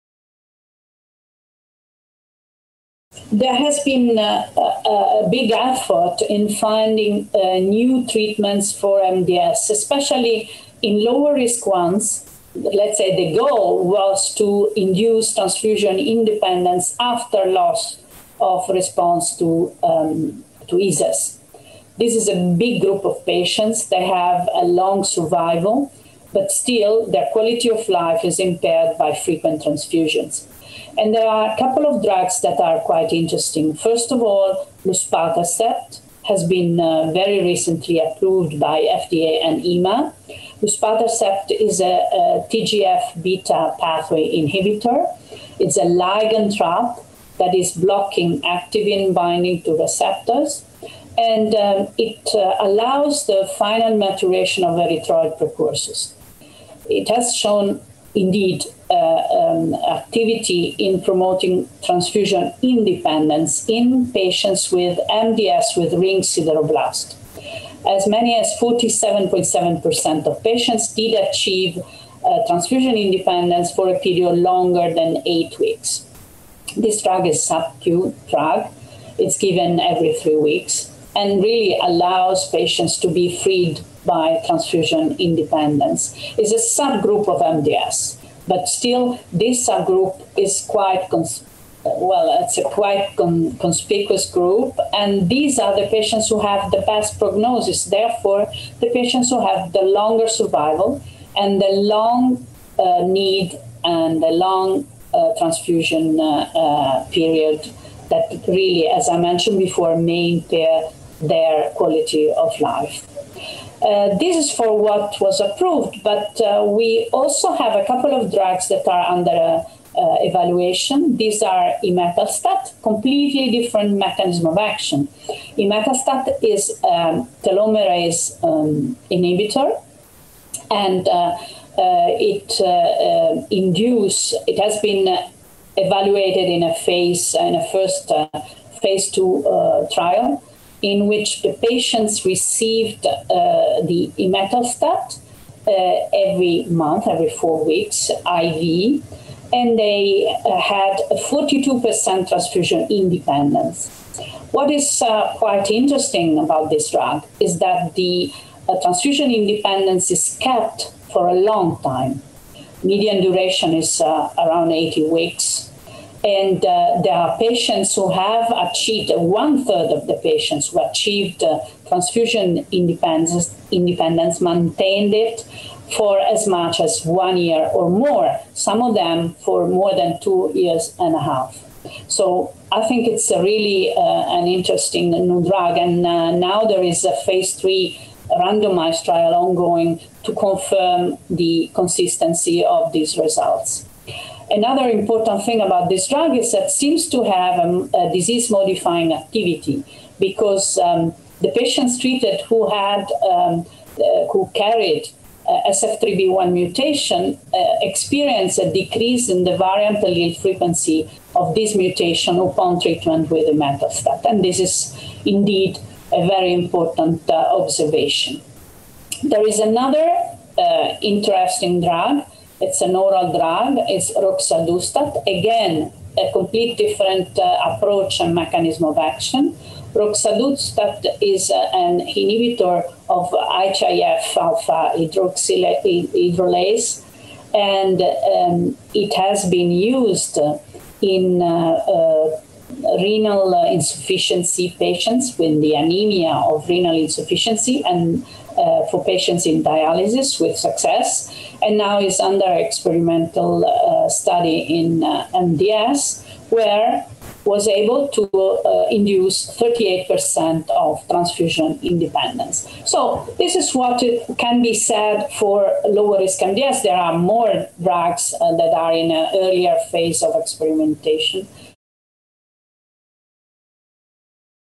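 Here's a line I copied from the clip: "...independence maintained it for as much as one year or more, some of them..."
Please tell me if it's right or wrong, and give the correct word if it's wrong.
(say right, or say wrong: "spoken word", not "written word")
right.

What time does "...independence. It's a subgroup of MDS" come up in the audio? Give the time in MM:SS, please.
01:25.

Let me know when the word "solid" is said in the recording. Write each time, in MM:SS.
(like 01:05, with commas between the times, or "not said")
not said.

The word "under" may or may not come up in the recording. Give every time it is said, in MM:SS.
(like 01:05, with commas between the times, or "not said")
01:59, 04:12.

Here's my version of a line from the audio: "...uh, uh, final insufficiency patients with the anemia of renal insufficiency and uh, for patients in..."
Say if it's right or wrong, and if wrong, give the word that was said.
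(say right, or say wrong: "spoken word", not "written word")
wrong: "renal", not "final".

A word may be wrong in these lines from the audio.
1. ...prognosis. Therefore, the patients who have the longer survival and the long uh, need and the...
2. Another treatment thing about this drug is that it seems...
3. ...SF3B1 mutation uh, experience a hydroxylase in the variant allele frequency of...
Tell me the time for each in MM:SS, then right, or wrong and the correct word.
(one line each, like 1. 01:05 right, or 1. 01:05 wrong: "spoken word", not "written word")
1. 01:37 right
2. 03:14 wrong: "important", not "treatment"
3. 03:25 wrong: "decrease", not "hydroxylase".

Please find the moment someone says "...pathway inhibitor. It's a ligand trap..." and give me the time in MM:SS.
00:43.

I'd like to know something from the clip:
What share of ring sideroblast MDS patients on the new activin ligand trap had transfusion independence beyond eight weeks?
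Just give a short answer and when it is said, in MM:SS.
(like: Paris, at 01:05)
47.7%, at 01:08.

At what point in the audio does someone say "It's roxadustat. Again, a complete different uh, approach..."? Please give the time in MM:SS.
03:43.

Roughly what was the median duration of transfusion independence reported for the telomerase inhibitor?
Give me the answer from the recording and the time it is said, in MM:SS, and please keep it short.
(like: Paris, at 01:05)
80 weeks, at 02:44.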